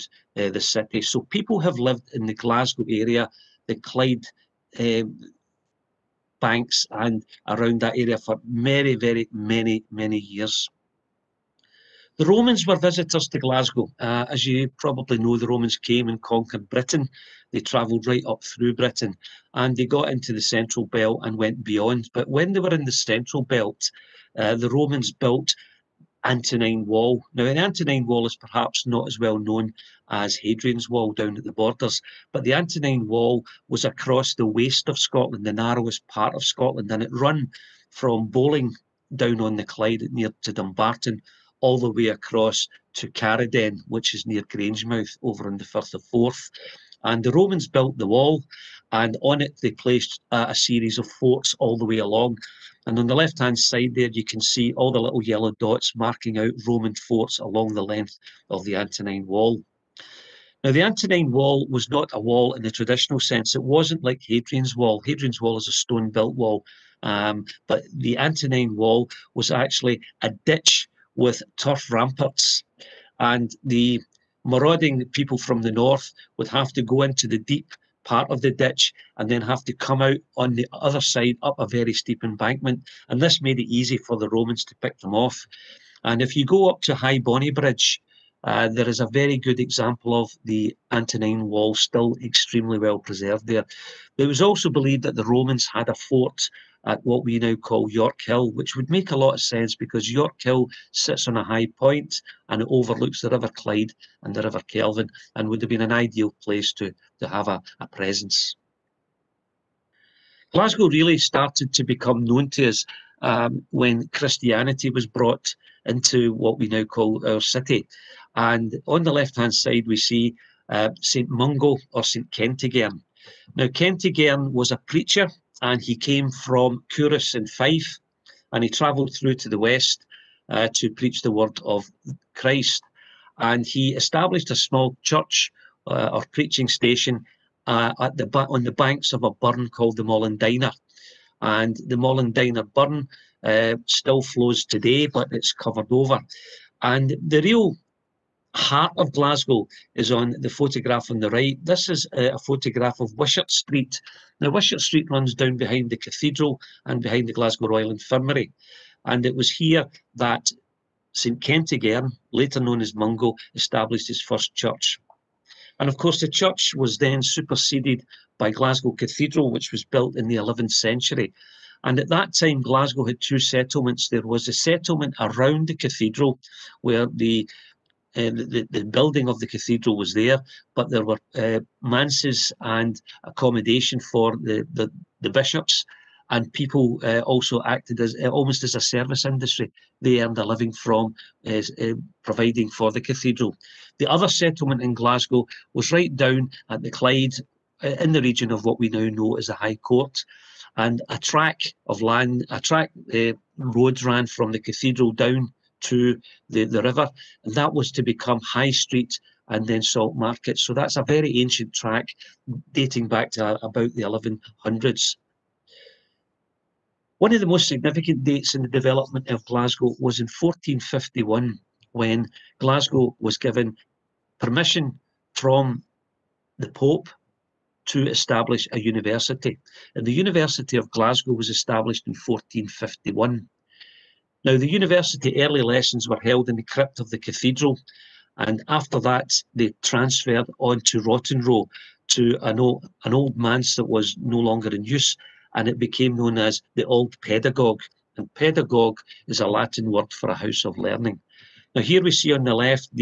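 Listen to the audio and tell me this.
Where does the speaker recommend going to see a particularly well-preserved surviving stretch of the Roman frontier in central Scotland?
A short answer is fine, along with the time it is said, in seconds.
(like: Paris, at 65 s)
High Bonnybridge, at 86 s.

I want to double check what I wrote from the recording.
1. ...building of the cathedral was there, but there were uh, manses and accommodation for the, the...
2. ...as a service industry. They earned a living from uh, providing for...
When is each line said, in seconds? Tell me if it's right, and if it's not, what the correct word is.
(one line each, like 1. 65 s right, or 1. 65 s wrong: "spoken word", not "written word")
1. 178 s right
2. 188 s right.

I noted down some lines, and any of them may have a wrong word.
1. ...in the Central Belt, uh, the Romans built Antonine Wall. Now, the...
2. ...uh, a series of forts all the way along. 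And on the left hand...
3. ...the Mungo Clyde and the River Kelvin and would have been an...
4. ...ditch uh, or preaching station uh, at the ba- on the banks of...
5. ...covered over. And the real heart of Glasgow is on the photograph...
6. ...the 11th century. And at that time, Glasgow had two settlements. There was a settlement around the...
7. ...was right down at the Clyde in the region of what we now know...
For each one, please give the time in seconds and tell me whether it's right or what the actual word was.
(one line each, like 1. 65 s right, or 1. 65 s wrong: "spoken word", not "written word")
1. 22 s right
2. 50 s right
3. 103 s wrong: "River", not "Mungo"
4. 135 s wrong: "church", not "ditch"
5. 145 s right
6. 170 s right
7. 195 s right.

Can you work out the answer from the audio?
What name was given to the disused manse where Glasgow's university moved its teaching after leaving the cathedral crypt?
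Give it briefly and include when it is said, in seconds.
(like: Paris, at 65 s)
Old Pedagogue, at 246 s.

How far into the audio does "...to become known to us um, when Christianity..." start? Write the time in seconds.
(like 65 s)
111 s.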